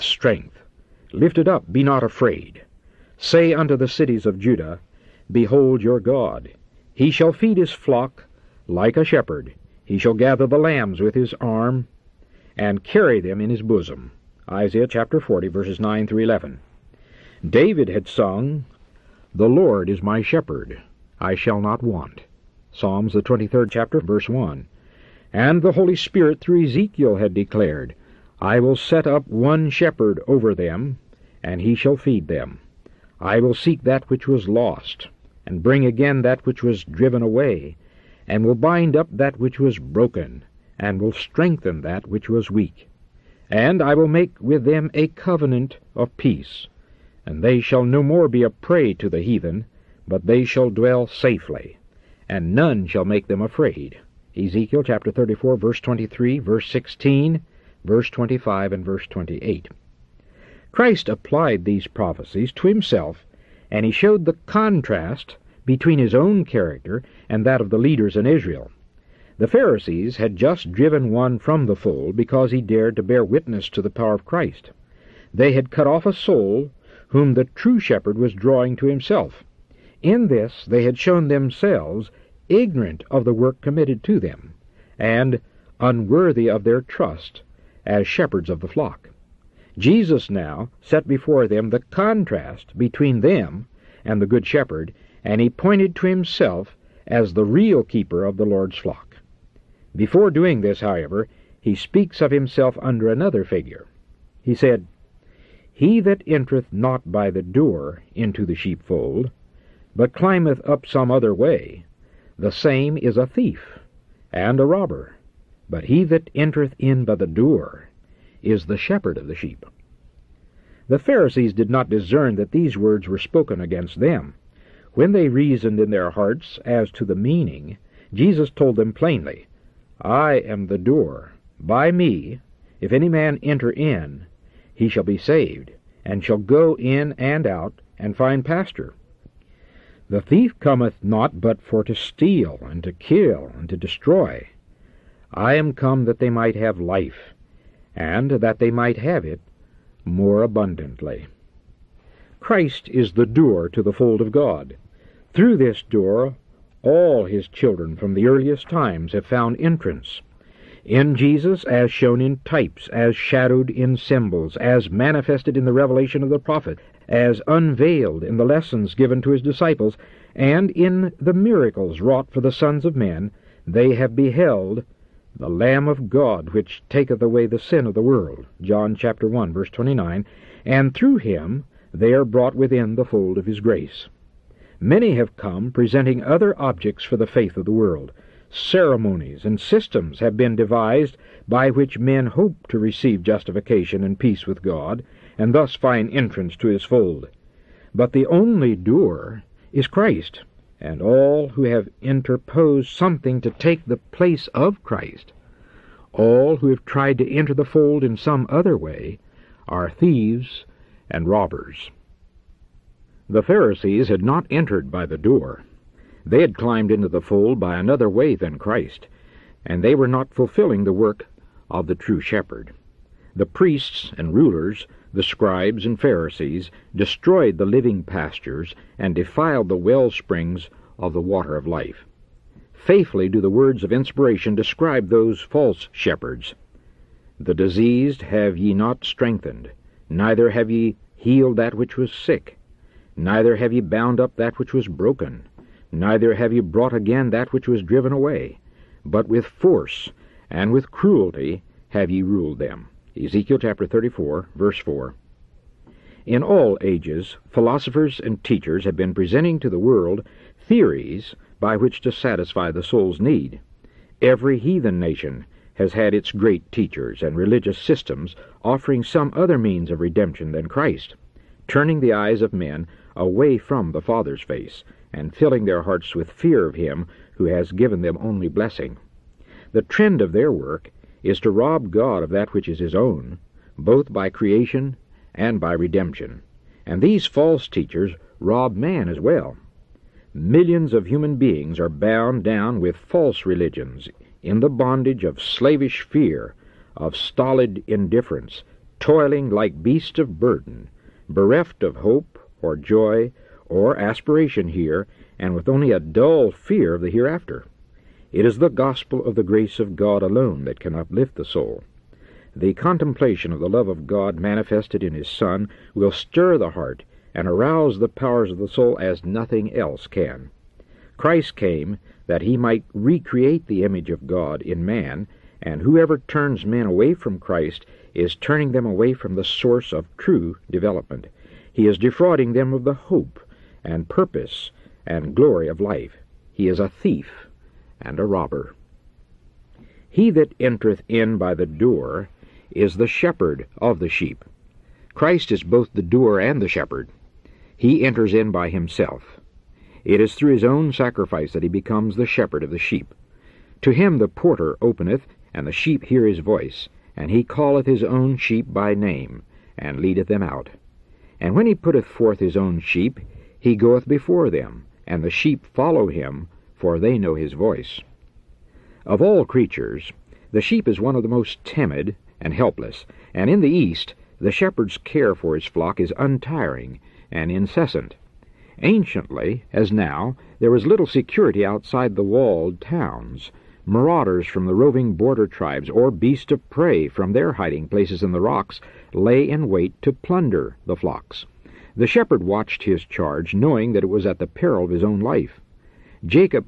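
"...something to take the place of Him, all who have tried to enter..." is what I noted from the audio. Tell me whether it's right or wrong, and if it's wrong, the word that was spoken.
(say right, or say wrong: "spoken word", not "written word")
wrong: "Christ", not "Him".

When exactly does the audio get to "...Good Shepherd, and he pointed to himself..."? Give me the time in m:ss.
1:34.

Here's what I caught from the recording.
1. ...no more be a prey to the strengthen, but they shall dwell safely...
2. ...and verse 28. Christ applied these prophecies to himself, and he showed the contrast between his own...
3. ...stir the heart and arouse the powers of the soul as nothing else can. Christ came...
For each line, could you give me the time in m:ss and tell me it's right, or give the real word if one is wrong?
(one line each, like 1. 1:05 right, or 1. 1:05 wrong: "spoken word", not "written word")
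1. 0:47 wrong: "heathen", not "strengthen"
2. 0:58 right
3. 5:16 right.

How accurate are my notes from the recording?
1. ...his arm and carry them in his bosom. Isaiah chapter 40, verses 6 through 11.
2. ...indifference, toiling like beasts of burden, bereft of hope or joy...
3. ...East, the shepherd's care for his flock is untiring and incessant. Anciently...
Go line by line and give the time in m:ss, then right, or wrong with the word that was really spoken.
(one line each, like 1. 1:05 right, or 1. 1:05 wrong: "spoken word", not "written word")
1. 0:11 wrong: "9", not "6"
2. 4:57 right
3. 6:13 right.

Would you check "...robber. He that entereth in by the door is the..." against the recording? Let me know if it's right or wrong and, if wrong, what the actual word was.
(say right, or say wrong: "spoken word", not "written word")
right.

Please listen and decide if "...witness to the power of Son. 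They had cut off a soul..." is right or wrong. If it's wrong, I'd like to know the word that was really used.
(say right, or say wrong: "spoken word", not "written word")
wrong: "Christ", not "Son".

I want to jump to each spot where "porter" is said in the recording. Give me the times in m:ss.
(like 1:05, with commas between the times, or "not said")
5:54.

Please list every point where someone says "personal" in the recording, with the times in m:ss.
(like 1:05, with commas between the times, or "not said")
not said.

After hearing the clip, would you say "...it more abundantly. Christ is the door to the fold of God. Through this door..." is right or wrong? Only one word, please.
right.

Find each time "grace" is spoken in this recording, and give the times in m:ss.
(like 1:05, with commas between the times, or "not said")
3:03, 5:09.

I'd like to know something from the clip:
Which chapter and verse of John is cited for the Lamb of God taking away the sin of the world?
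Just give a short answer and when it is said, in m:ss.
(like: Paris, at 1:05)
Chapter 1, verse 29, at 2:58.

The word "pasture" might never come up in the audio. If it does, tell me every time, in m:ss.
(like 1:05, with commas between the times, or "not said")
2:18, 3:48.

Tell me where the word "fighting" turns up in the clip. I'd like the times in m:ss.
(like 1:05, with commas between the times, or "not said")
not said.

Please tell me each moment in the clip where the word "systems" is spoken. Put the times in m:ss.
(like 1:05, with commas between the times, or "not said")
3:09, 4:27.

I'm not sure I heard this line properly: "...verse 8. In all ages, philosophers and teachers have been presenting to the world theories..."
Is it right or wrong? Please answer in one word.
wrong.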